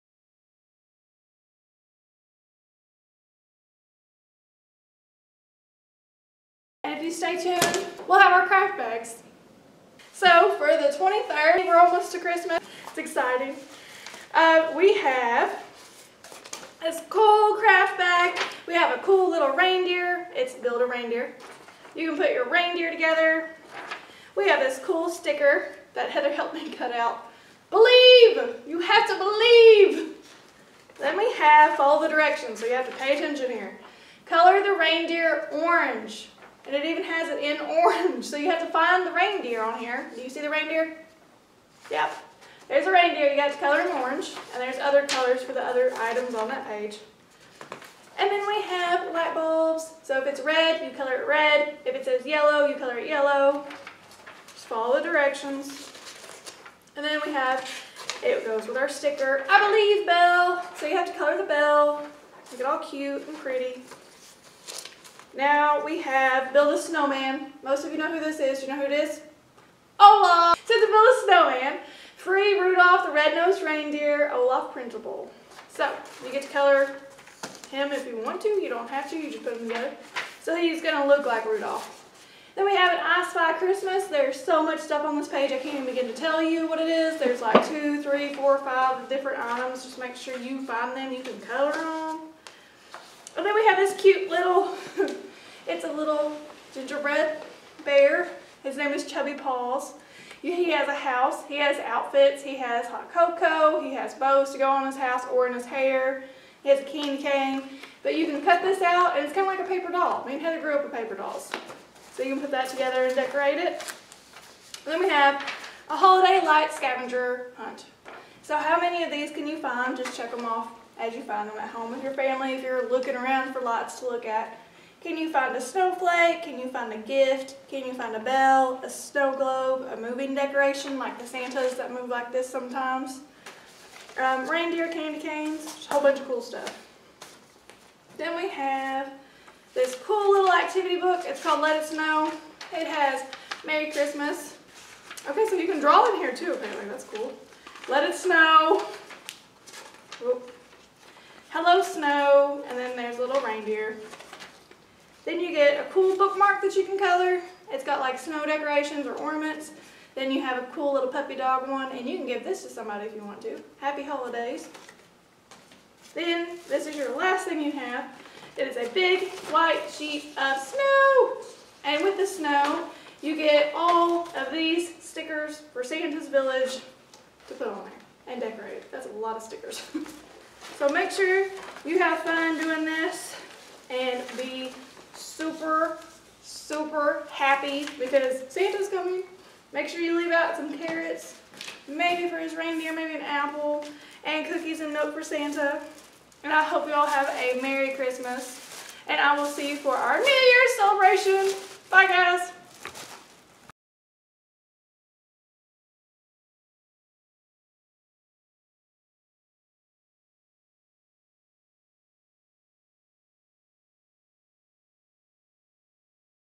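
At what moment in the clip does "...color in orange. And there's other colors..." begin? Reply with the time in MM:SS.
00:43.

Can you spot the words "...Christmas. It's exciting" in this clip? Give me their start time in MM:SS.
00:12.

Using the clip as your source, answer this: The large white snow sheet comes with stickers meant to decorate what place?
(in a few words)
Santa's Village.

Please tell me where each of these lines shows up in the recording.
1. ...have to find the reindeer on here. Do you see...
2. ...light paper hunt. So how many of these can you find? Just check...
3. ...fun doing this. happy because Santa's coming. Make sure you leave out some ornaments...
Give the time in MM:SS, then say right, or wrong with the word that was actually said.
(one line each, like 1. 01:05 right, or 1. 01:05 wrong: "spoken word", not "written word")
1. 00:38 right
2. 01:56 wrong: "scavenger", not "paper"
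3. 03:02 wrong: "carrots", not "ornaments".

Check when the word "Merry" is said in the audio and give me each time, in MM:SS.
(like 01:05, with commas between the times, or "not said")
02:23, 03:17.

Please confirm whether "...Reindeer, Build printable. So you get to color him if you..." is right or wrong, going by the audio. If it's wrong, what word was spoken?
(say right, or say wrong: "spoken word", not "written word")
wrong: "Olaf", not "Build".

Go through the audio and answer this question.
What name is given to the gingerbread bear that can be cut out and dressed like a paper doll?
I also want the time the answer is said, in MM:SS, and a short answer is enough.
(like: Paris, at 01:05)
Chubby Paws, at 01:39.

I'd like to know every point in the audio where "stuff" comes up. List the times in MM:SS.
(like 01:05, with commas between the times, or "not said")
01:24, 02:16.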